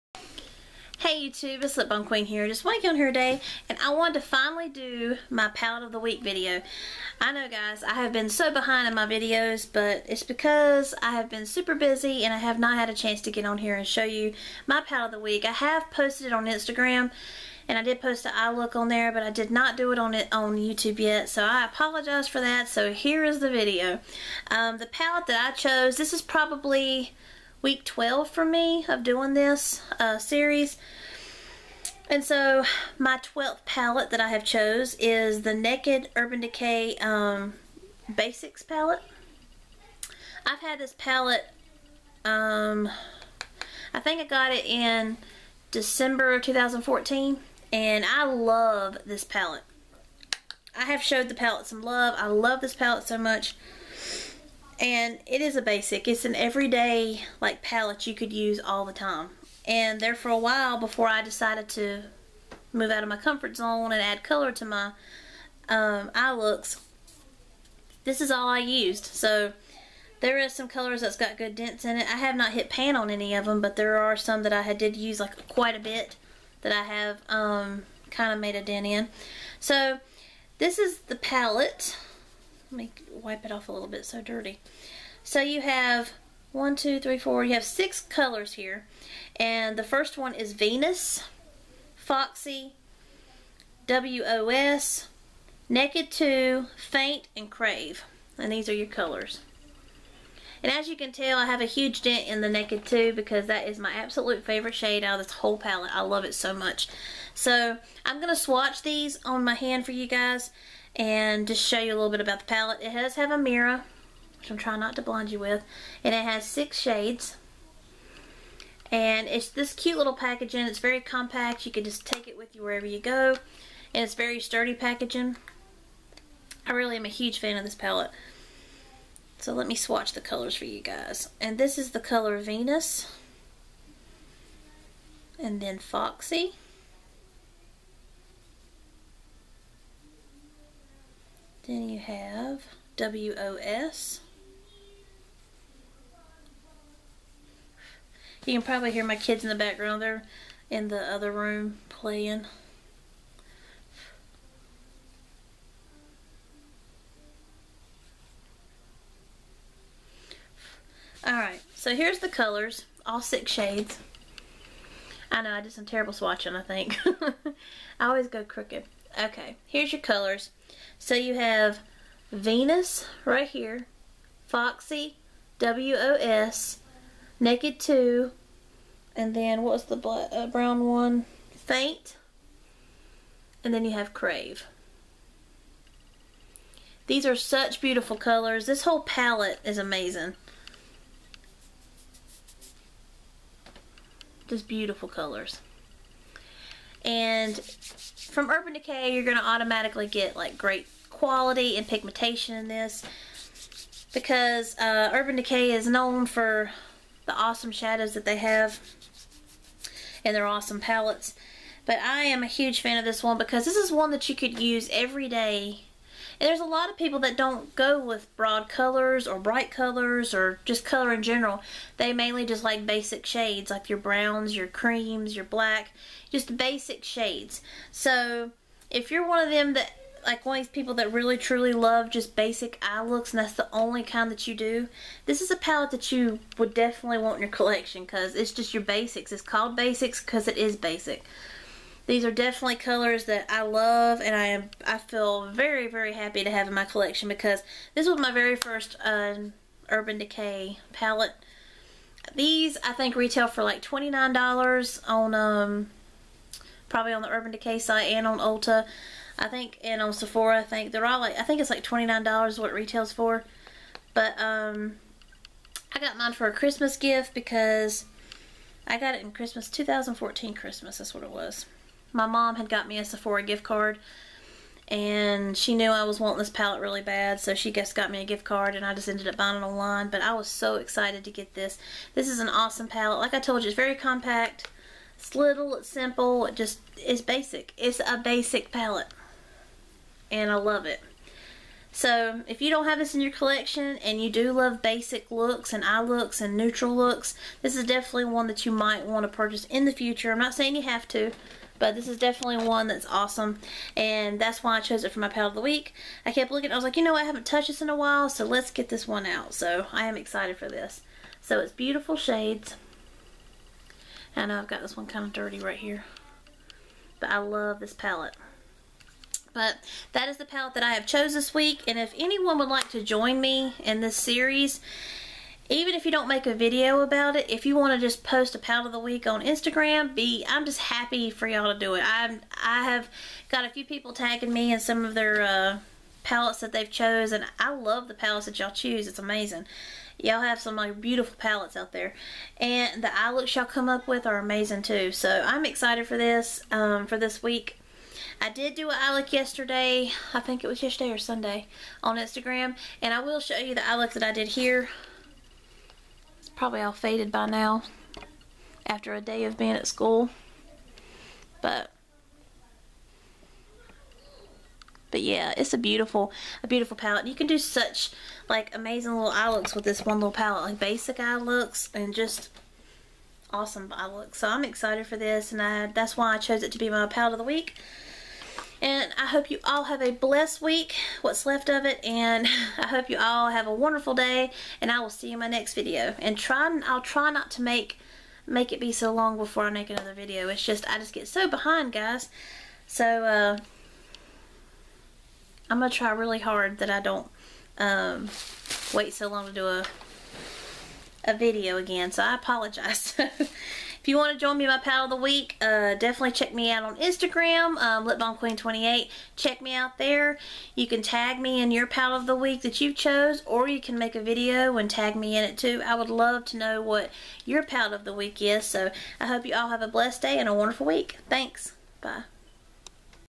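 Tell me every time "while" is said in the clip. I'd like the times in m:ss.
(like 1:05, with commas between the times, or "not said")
1:00, 5:07.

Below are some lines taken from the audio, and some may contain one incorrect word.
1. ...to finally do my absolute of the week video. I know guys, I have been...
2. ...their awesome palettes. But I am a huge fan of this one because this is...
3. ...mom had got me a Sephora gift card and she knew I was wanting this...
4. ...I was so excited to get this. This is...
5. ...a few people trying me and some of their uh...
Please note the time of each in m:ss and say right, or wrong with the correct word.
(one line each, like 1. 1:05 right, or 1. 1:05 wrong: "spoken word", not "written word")
1. 0:04 wrong: "palette", not "absolute"
2. 3:30 right
3. 4:32 right
4. 4:40 right
5. 5:33 wrong: "tagging", not "trying".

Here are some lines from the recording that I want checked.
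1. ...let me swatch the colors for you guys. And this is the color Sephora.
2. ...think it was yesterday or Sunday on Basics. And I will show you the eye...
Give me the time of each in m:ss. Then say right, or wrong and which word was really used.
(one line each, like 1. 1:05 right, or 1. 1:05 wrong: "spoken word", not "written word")
1. 2:09 wrong: "Venus", not "Sephora"
2. 5:50 wrong: "Instagram", not "Basics".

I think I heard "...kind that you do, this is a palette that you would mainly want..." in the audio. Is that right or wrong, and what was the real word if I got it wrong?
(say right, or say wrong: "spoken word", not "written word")
wrong: "definitely", not "mainly".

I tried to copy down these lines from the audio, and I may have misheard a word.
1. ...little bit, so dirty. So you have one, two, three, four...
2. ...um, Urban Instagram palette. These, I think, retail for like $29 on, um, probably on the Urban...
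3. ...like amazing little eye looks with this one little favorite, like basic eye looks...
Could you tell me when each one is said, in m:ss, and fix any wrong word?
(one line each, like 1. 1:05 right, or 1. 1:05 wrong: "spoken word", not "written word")
1. 1:23 right
2. 4:09 wrong: "Decay", not "Instagram"
3. 6:08 wrong: "palette", not "favorite".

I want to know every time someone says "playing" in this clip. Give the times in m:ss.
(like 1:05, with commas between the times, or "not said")
2:31.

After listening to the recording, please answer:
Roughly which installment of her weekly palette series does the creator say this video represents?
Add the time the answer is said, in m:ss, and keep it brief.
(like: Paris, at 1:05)
12, at 0:27.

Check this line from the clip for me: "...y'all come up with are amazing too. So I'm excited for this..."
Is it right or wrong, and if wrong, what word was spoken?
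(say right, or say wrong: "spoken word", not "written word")
right.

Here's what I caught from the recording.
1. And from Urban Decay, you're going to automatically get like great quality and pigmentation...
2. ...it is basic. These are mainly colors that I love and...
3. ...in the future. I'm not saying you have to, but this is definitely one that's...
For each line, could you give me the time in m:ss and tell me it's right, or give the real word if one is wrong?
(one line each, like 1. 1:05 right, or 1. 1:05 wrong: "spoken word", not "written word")
1. 3:17 right
2. 4:00 wrong: "definitely", not "mainly"
3. 4:59 right.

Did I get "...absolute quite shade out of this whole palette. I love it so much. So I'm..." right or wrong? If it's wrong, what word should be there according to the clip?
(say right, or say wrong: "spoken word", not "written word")
wrong: "favorite", not "quite".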